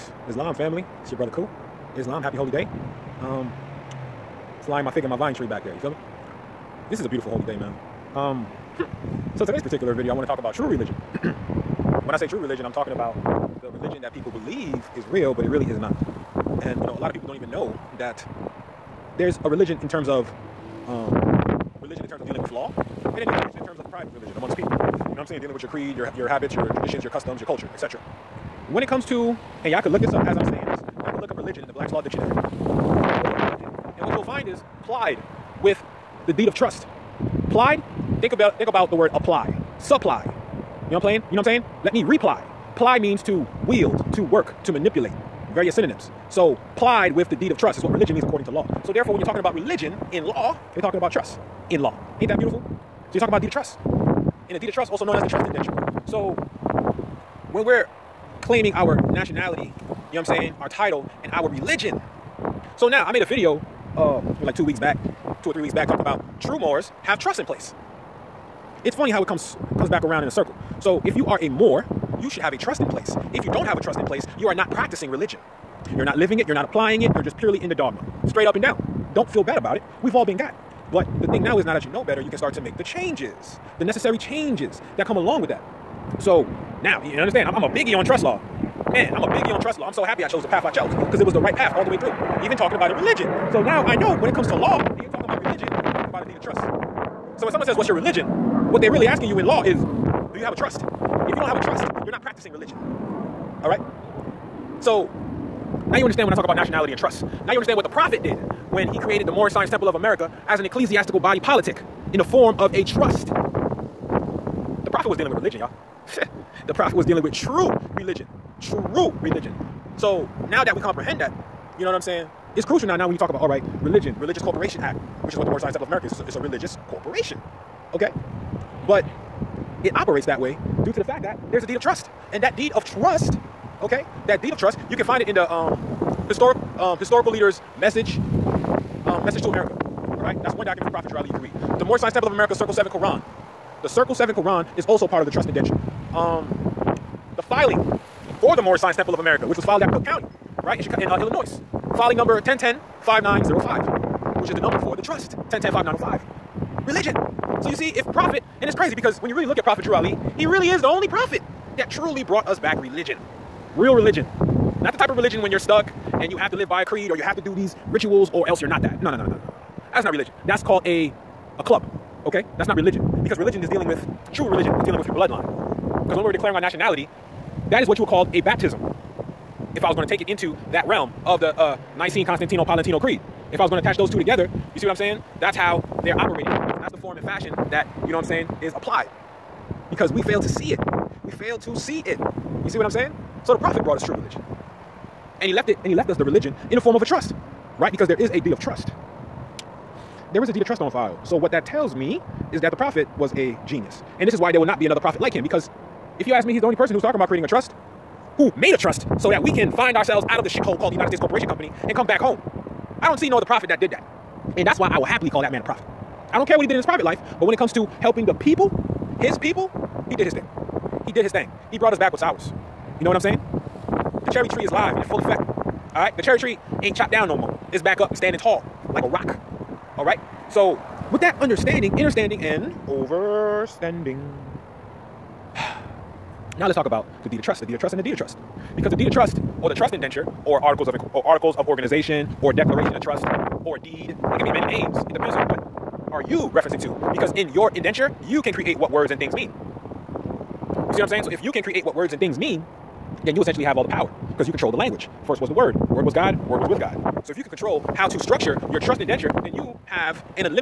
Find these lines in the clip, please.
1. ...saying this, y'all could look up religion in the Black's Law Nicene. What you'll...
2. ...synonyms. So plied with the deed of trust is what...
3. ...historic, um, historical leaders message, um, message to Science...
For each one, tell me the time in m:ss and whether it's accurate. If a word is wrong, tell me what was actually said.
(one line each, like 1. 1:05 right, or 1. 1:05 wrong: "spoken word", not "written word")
1. 0:30 wrong: "Dictionary", not "Nicene"
2. 0:45 right
3. 2:16 wrong: "America", not "Science".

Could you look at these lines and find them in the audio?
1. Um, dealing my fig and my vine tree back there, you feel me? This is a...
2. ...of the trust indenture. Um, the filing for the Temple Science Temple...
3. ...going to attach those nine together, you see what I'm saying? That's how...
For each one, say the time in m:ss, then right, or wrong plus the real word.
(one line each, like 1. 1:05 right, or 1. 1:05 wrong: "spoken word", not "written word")
1. 0:03 wrong: "flying", not "dealing"
2. 2:25 wrong: "Moorish", not "Temple"
3. 3:03 wrong: "two", not "nine".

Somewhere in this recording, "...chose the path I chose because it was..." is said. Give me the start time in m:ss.
1:30.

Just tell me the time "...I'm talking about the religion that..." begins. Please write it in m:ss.
0:12.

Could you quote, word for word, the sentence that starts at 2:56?
Because when we're declaring our nationality, that is what you would call a baptism.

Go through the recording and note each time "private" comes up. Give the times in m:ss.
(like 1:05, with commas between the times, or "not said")
0:23, 3:36.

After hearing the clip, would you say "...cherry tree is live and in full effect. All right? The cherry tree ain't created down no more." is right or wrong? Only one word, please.
wrong.